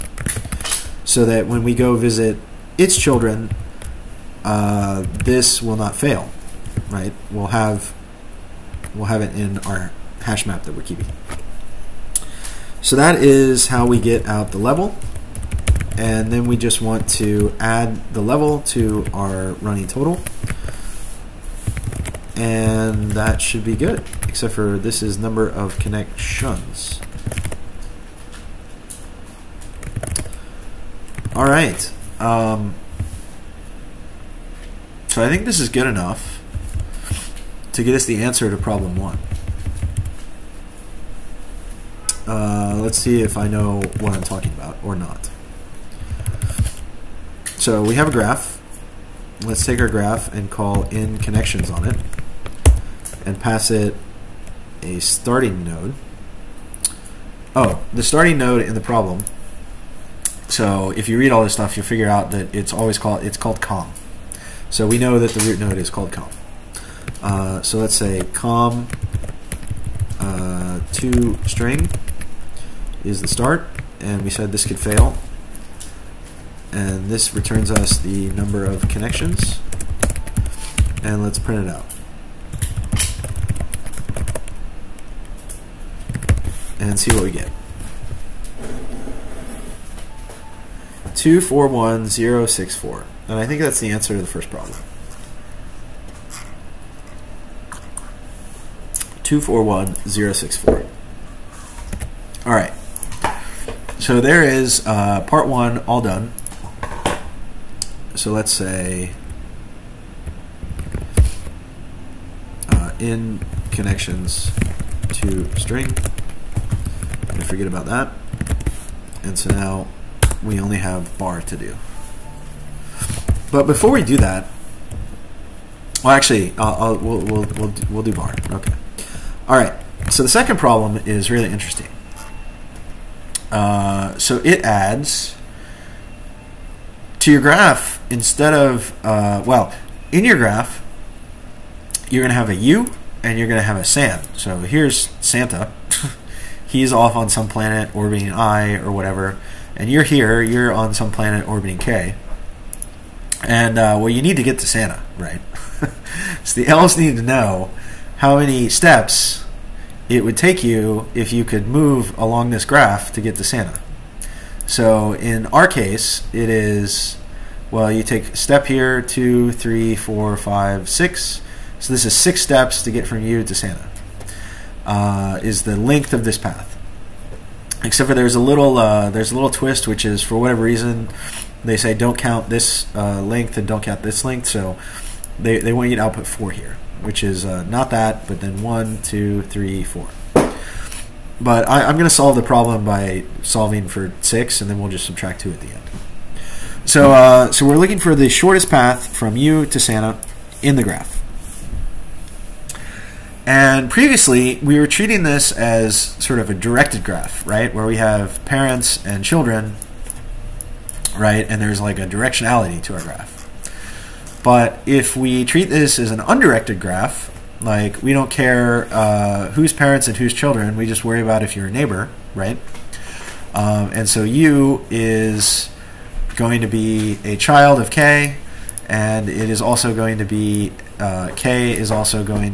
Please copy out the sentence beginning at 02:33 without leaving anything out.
And uh, well, you need to get to Santa, right?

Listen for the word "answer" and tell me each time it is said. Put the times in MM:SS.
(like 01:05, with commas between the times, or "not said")
00:38, 01:33.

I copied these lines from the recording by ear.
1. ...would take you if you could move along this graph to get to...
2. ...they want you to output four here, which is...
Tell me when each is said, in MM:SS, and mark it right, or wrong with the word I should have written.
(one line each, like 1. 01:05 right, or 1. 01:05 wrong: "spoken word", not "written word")
1. 02:40 right
2. 03:05 right.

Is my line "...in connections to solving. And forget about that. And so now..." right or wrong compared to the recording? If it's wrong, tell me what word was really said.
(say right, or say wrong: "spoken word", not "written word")
wrong: "string", not "solving".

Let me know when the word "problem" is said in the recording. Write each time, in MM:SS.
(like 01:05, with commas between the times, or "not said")
00:38, 00:58, 01:34, 02:10, 03:12.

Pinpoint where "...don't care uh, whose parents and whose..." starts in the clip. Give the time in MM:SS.
03:38.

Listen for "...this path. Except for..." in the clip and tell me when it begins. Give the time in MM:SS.
02:56.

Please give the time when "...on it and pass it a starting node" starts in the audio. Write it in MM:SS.
00:51.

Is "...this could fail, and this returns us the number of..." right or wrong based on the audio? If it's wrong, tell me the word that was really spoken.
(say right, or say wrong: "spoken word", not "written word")
right.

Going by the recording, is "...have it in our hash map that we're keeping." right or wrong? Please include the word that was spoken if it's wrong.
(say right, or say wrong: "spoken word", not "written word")
right.